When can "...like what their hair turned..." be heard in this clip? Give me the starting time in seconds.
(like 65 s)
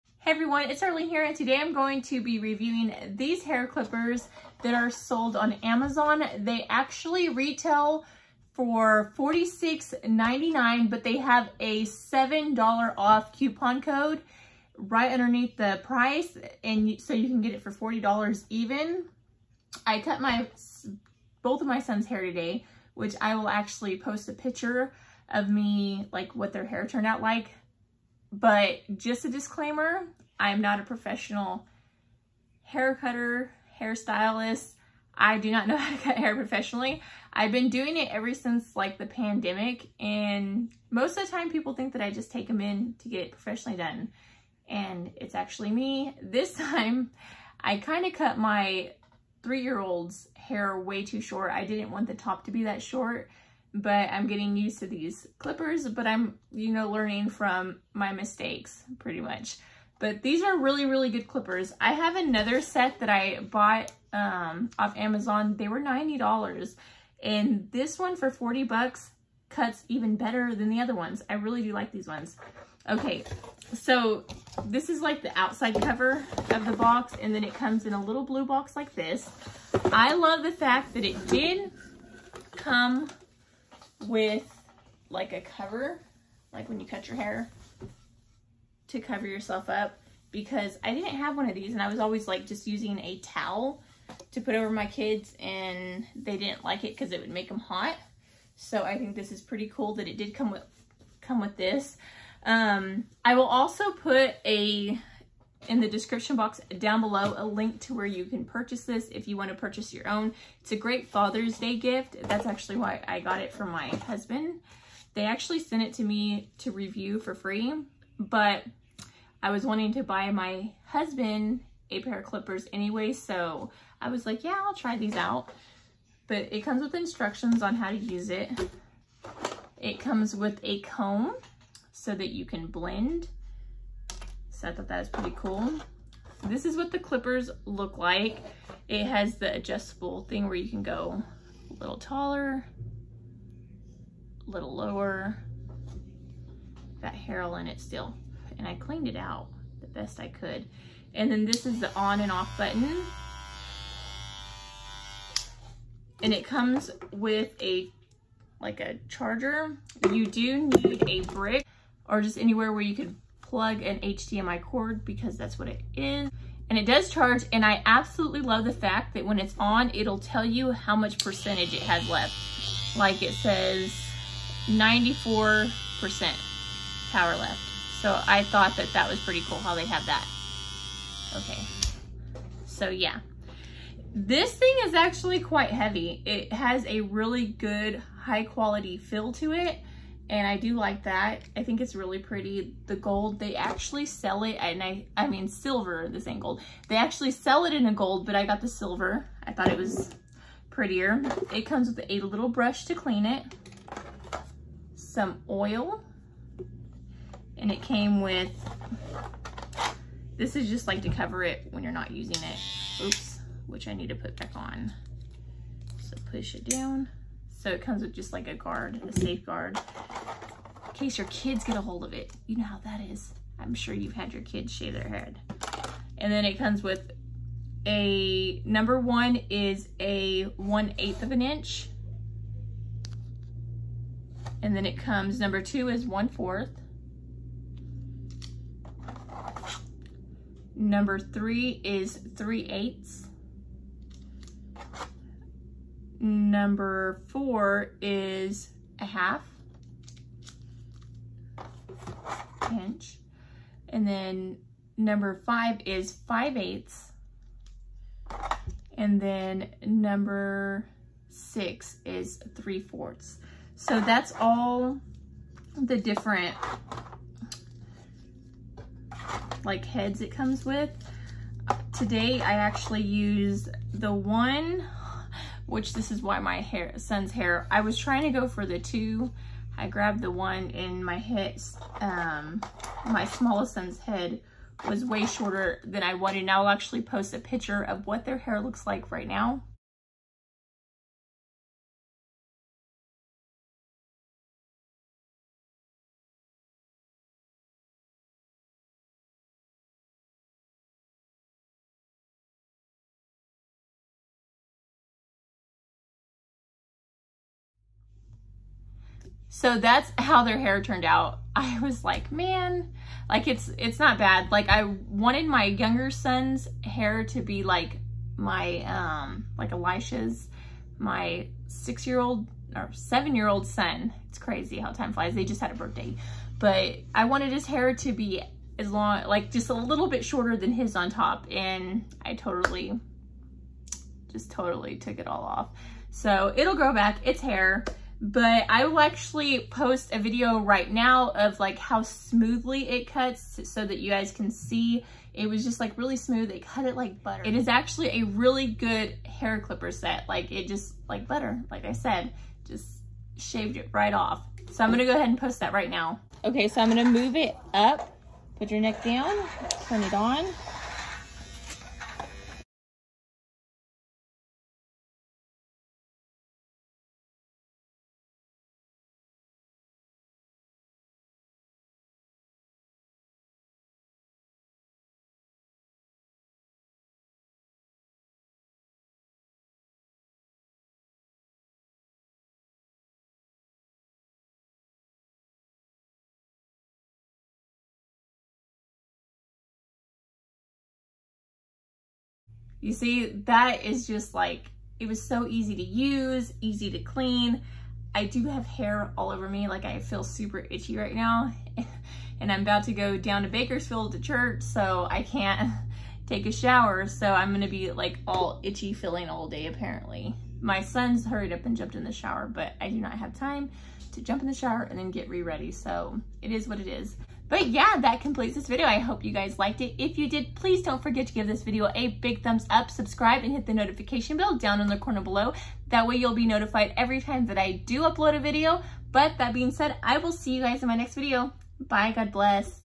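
26 s.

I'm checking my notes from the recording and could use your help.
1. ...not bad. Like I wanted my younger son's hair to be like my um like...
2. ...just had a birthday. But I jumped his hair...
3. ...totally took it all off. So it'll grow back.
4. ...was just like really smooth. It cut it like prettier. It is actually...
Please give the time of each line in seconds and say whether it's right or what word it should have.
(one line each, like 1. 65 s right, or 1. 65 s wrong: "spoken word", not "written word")
1. 313 s right
2. 325 s wrong: "wanted", not "jumped"
3. 334 s right
4. 345 s wrong: "butter", not "prettier".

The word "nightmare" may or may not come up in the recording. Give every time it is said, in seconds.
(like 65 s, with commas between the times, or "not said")
not said.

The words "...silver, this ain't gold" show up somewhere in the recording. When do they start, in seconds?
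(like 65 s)
195 s.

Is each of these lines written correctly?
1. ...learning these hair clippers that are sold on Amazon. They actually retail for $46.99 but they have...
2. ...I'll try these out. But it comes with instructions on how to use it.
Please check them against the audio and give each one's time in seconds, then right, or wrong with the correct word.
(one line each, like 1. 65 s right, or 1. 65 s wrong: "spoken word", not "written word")
1. 2 s wrong: "reviewing", not "learning"
2. 124 s right.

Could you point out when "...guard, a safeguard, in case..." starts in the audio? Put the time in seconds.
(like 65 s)
218 s.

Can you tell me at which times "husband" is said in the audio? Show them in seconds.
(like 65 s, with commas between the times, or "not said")
113 s, 120 s.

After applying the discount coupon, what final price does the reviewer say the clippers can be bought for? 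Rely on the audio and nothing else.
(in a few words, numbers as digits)
$40.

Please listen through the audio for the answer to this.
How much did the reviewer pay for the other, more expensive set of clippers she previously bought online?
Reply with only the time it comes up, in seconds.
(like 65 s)
65 s.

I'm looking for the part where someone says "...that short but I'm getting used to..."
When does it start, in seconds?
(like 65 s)
52 s.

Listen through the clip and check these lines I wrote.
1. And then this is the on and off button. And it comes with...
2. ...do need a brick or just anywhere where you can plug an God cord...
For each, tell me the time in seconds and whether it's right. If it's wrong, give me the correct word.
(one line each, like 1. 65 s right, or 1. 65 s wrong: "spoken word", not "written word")
1. 151 s right
2. 160 s wrong: "HDMI", not "God".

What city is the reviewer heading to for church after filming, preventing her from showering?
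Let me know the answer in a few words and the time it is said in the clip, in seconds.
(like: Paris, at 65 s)
Bakersfield, at 403 s.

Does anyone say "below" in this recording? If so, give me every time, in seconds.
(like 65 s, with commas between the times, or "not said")
107 s, 425 s.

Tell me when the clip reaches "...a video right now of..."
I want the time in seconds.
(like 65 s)
340 s.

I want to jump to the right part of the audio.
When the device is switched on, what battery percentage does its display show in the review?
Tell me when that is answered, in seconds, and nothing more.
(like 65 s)
174 s.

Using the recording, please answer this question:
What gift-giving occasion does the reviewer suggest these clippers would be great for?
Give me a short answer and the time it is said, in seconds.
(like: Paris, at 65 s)
Father's Day, at 111 s.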